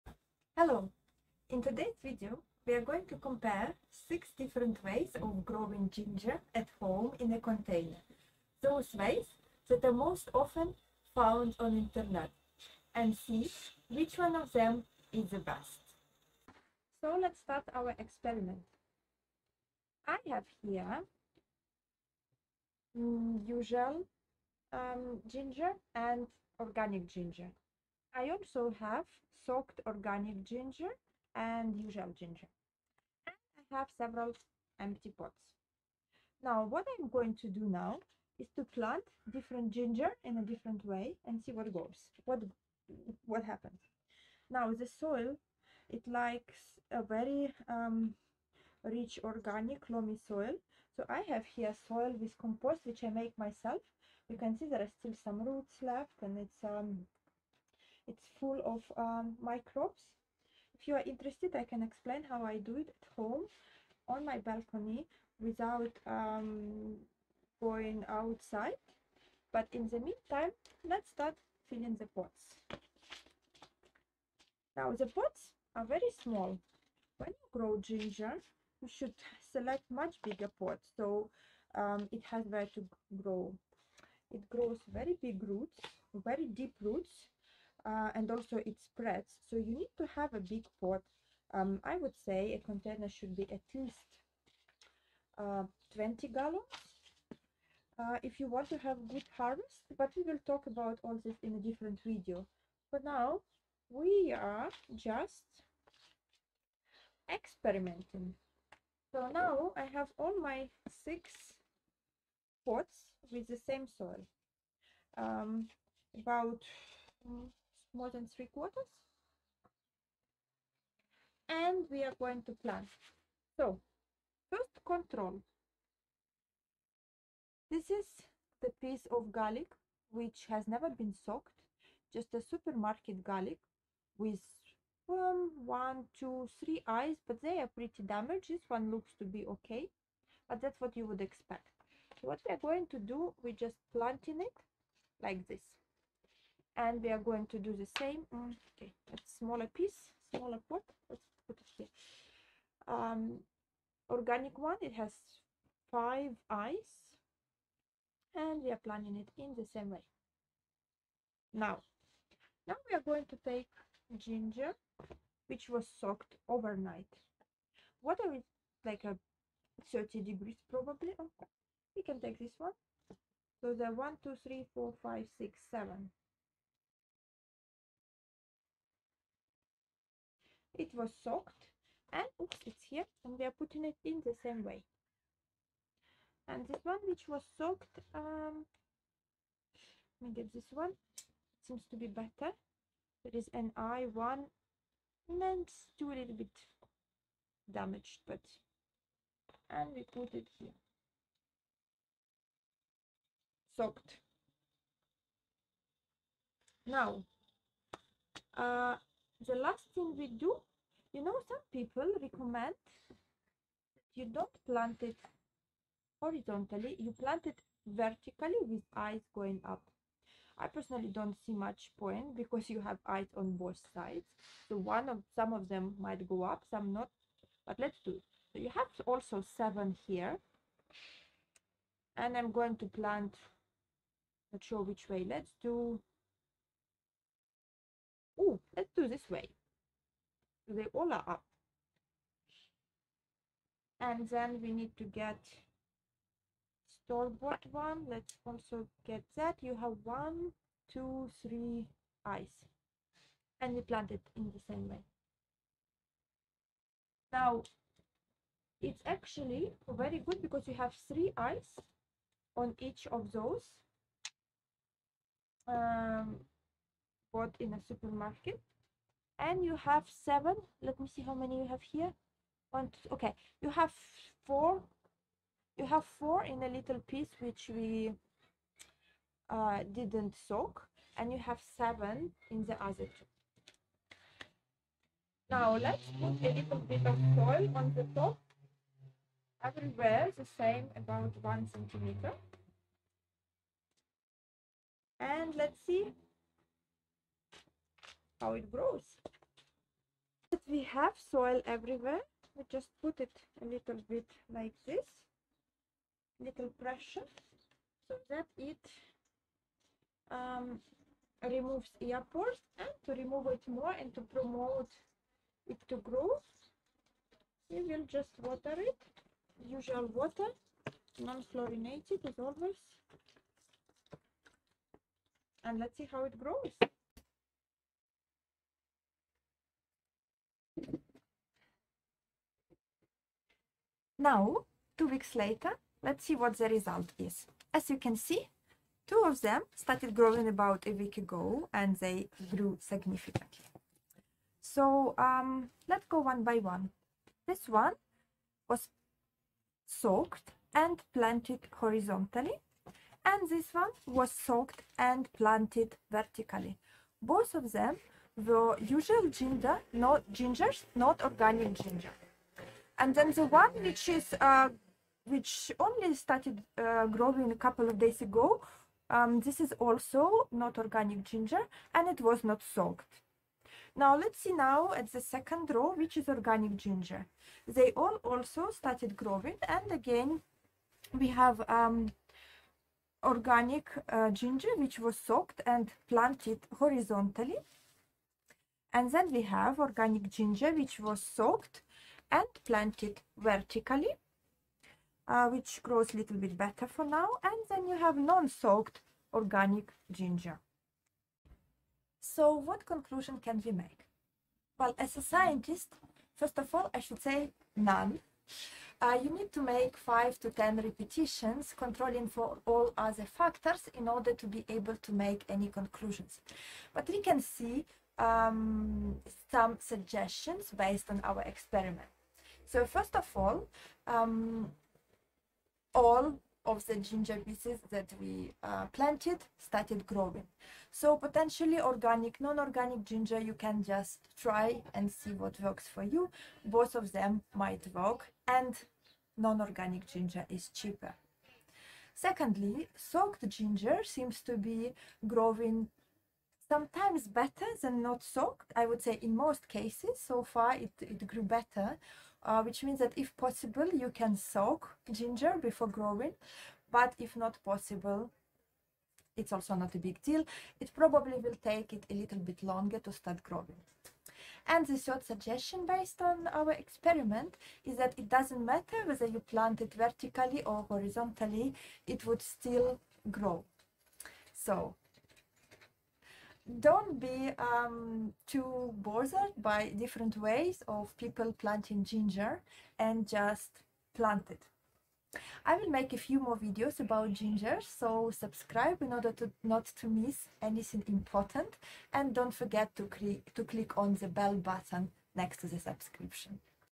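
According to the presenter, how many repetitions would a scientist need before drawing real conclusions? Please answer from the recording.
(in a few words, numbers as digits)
5 to 10.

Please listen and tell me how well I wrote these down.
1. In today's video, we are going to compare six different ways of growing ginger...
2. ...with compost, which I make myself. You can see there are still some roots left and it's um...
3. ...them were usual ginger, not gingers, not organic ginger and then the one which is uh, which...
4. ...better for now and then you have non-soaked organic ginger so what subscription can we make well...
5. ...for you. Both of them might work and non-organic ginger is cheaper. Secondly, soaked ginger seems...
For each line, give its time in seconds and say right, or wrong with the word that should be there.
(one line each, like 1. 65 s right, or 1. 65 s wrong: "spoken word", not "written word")
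1. 1 s right
2. 52 s right
3. 357 s right
4. 396 s wrong: "conclusion", not "subscription"
5. 435 s right.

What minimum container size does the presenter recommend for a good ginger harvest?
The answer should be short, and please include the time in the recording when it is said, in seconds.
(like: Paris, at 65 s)
20 gallons, at 95 s.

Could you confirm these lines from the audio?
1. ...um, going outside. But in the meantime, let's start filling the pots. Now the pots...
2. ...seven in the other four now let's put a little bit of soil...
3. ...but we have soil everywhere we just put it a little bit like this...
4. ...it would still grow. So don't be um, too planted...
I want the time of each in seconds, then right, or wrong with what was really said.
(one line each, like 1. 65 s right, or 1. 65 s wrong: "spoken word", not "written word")
1. 66 s right
2. 281 s wrong: "two", not "four"
3. 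300 s right
4. 472 s wrong: "bothered", not "planted".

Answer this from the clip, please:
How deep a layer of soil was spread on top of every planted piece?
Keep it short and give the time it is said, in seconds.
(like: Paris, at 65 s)
1 centimeter, at 291 s.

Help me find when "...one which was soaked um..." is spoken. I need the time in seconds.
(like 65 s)
186 s.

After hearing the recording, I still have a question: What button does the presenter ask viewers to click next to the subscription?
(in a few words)
bell button.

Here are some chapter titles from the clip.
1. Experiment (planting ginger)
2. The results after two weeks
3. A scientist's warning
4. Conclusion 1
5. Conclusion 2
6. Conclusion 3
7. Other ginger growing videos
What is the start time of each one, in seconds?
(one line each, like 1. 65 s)
1. 15 s
2. 327 s
3. 401 s
4. 423 s
5. 441 s
6. 463 s
7. 487 s.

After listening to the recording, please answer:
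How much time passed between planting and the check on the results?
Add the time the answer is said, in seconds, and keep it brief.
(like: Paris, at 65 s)
2 weeks, at 334 s.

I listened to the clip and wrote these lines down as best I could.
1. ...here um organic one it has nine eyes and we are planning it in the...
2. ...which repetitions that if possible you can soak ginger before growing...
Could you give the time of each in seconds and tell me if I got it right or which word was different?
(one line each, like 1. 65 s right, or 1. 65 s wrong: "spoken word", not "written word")
1. 151 s wrong: "five", not "nine"
2. 452 s wrong: "means", not "repetitions".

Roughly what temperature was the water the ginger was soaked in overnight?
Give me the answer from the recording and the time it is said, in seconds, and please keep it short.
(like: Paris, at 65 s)
30 degrees, at 169 s.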